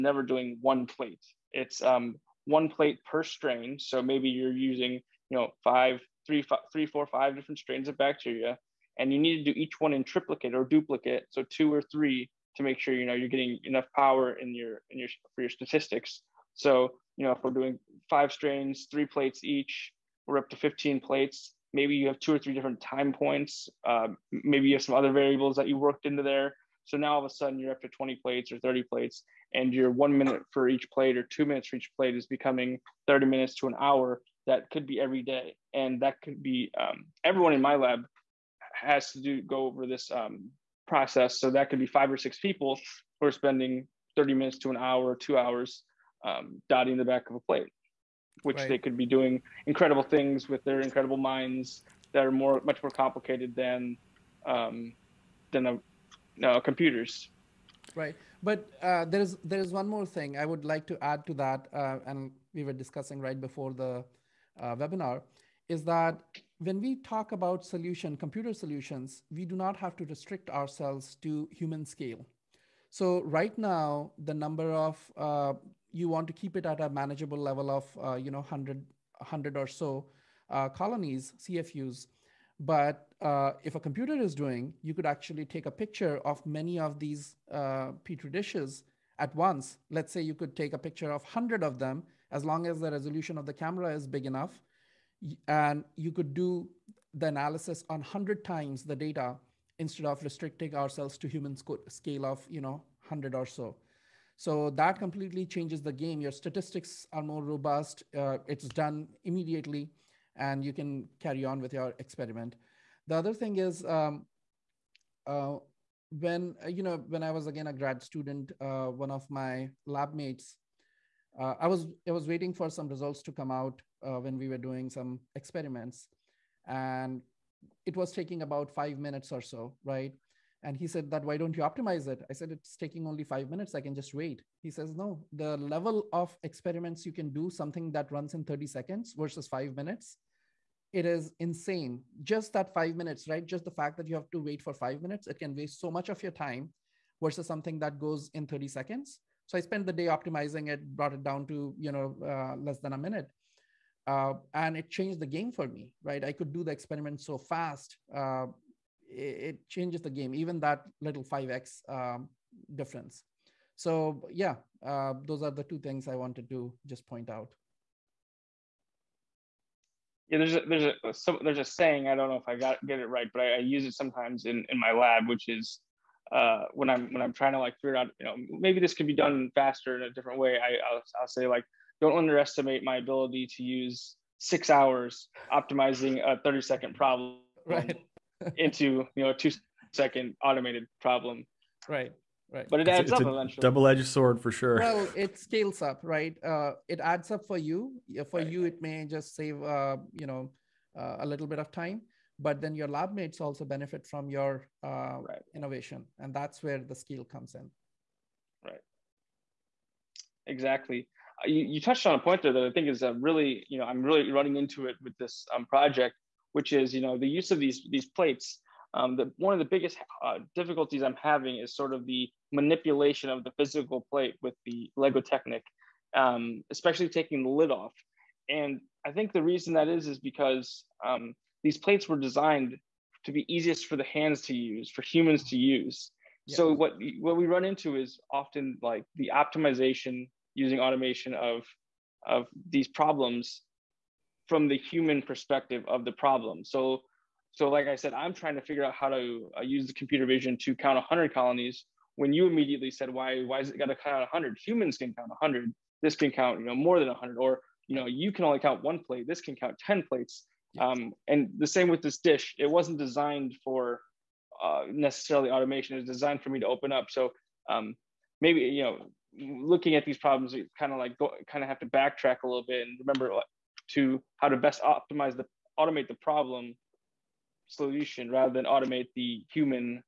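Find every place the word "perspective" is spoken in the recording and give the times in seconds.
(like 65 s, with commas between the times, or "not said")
245 s.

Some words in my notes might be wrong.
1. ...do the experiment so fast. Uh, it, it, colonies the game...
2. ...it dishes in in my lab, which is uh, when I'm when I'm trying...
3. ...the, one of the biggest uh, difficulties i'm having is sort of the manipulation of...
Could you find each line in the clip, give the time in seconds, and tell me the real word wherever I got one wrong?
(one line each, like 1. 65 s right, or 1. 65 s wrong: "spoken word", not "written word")
1. 156 s wrong: "changes", not "colonies"
2. 173 s wrong: "sometimes", not "dishes"
3. 219 s right.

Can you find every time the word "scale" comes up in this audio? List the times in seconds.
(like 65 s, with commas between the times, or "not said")
71 s, 101 s, 195 s.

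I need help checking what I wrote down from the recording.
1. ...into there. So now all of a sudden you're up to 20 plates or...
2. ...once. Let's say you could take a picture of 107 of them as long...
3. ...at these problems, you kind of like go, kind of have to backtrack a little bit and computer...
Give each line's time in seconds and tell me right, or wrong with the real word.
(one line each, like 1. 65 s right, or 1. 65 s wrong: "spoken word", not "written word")
1. 26 s right
2. 89 s wrong: "100", not "107"
3. 269 s wrong: "remember", not "computer".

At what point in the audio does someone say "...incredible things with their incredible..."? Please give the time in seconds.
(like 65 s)
49 s.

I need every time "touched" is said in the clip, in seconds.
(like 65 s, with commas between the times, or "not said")
211 s.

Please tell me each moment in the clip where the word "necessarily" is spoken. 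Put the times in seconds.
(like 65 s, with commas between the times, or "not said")
264 s.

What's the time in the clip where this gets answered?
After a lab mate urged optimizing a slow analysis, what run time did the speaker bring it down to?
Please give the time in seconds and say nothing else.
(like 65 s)
152 s.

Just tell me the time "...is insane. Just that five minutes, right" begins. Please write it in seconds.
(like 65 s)
141 s.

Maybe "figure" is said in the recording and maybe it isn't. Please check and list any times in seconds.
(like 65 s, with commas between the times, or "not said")
177 s, 248 s.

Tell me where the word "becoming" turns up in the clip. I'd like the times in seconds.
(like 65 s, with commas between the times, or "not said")
32 s.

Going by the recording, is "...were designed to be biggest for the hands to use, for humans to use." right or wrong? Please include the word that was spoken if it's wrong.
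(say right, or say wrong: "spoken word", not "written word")
wrong: "easiest", not "biggest".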